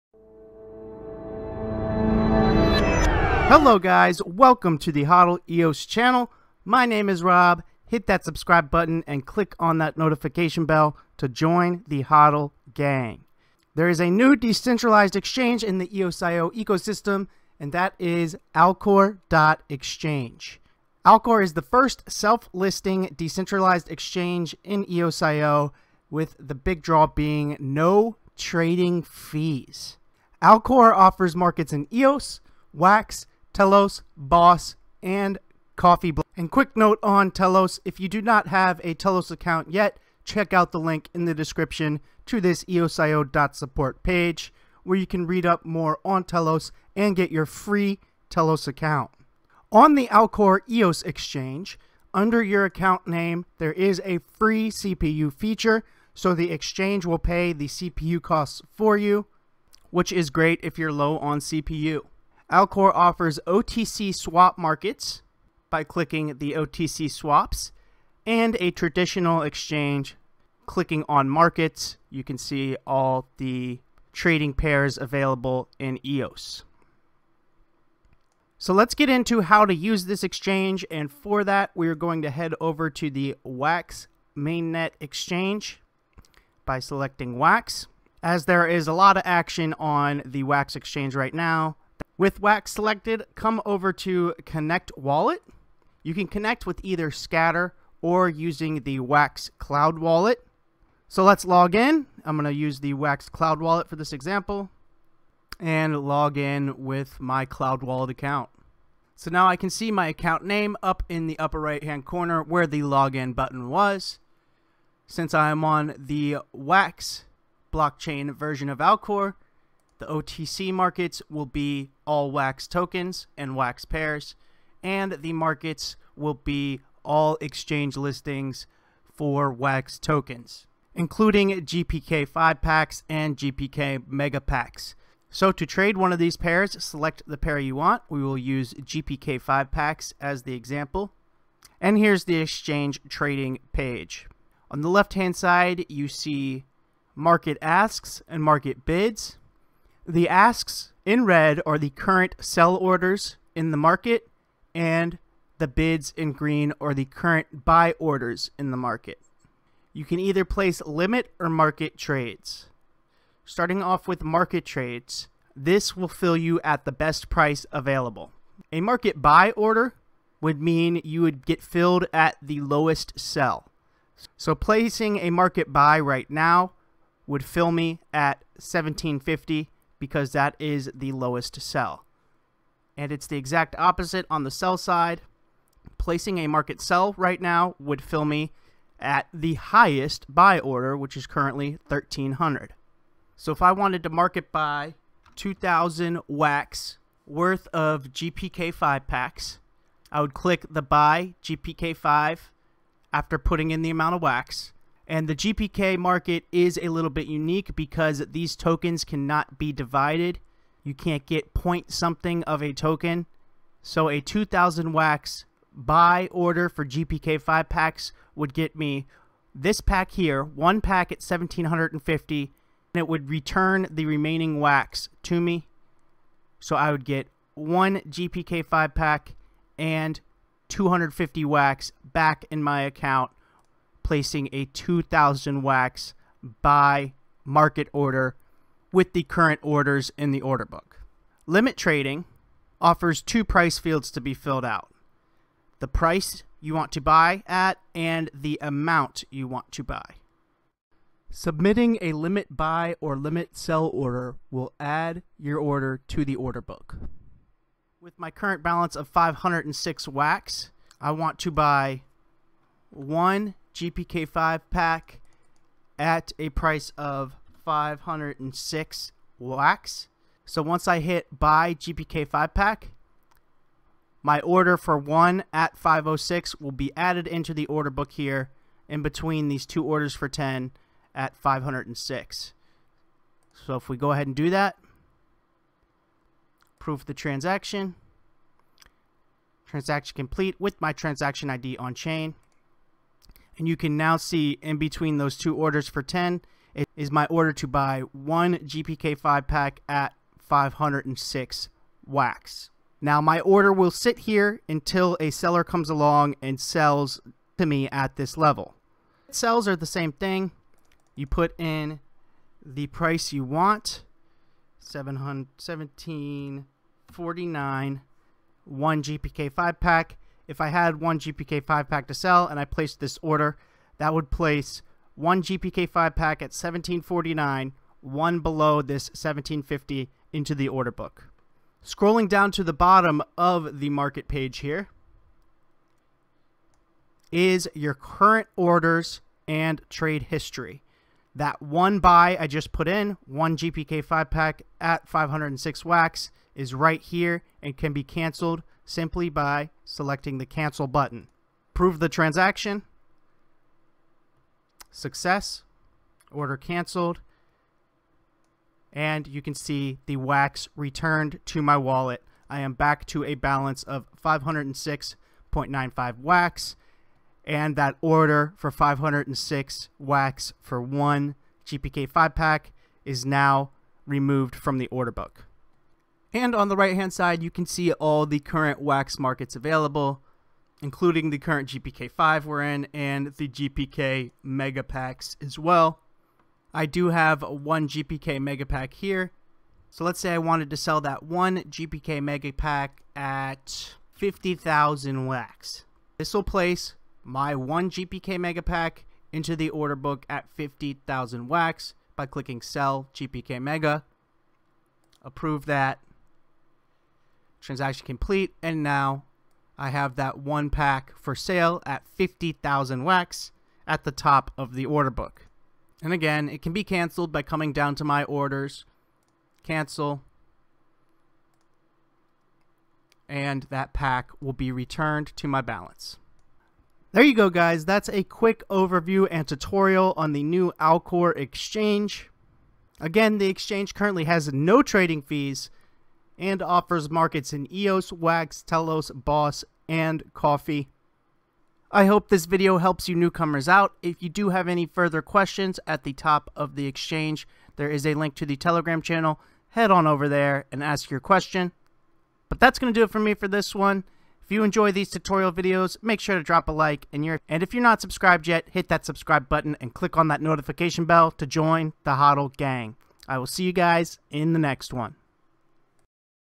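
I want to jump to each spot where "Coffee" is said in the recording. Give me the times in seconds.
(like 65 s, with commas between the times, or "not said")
35 s, 440 s.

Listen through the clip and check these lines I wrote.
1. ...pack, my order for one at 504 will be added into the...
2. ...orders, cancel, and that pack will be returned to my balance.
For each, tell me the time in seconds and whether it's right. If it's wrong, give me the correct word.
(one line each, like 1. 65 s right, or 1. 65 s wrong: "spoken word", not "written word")
1. 272 s wrong: "506", not "504"
2. 418 s right.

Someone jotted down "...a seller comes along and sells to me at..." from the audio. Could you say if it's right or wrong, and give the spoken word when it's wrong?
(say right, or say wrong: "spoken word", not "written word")
right.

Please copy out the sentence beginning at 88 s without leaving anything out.
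As there is a lot of action on the WAX exchange right now, with Wax selected, come over to Connect Wallet.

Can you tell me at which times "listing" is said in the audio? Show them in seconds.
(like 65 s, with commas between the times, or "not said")
22 s, 127 s.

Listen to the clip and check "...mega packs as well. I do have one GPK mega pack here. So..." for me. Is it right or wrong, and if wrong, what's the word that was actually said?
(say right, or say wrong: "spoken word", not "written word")
right.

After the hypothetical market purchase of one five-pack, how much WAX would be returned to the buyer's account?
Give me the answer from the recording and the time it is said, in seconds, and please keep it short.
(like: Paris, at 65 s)
250 wax, at 230 s.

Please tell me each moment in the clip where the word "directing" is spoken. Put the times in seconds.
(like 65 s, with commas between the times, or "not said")
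not said.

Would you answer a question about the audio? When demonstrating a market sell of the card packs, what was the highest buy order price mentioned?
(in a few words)
1300.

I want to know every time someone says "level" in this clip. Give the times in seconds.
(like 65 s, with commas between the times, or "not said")
308 s.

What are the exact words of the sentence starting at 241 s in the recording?
Limit trading offers two price fields to be filled out.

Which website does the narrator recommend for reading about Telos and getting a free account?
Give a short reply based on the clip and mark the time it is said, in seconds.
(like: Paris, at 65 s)
eosio.support, at 42 s.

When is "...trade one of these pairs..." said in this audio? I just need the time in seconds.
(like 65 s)
135 s.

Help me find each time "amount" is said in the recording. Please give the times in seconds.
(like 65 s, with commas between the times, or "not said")
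203 s, 248 s.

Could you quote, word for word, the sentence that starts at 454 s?
If you enjoy these tutorial videos, make sure to drop a like.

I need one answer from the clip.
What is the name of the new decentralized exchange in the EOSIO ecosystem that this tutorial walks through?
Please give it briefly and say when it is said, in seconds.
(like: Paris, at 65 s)
Alcor.exchange, at 18 s.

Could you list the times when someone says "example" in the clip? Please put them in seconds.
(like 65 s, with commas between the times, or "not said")
104 s, 140 s.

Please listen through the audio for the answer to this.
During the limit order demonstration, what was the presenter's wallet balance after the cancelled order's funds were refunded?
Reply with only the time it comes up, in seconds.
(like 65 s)
364 s.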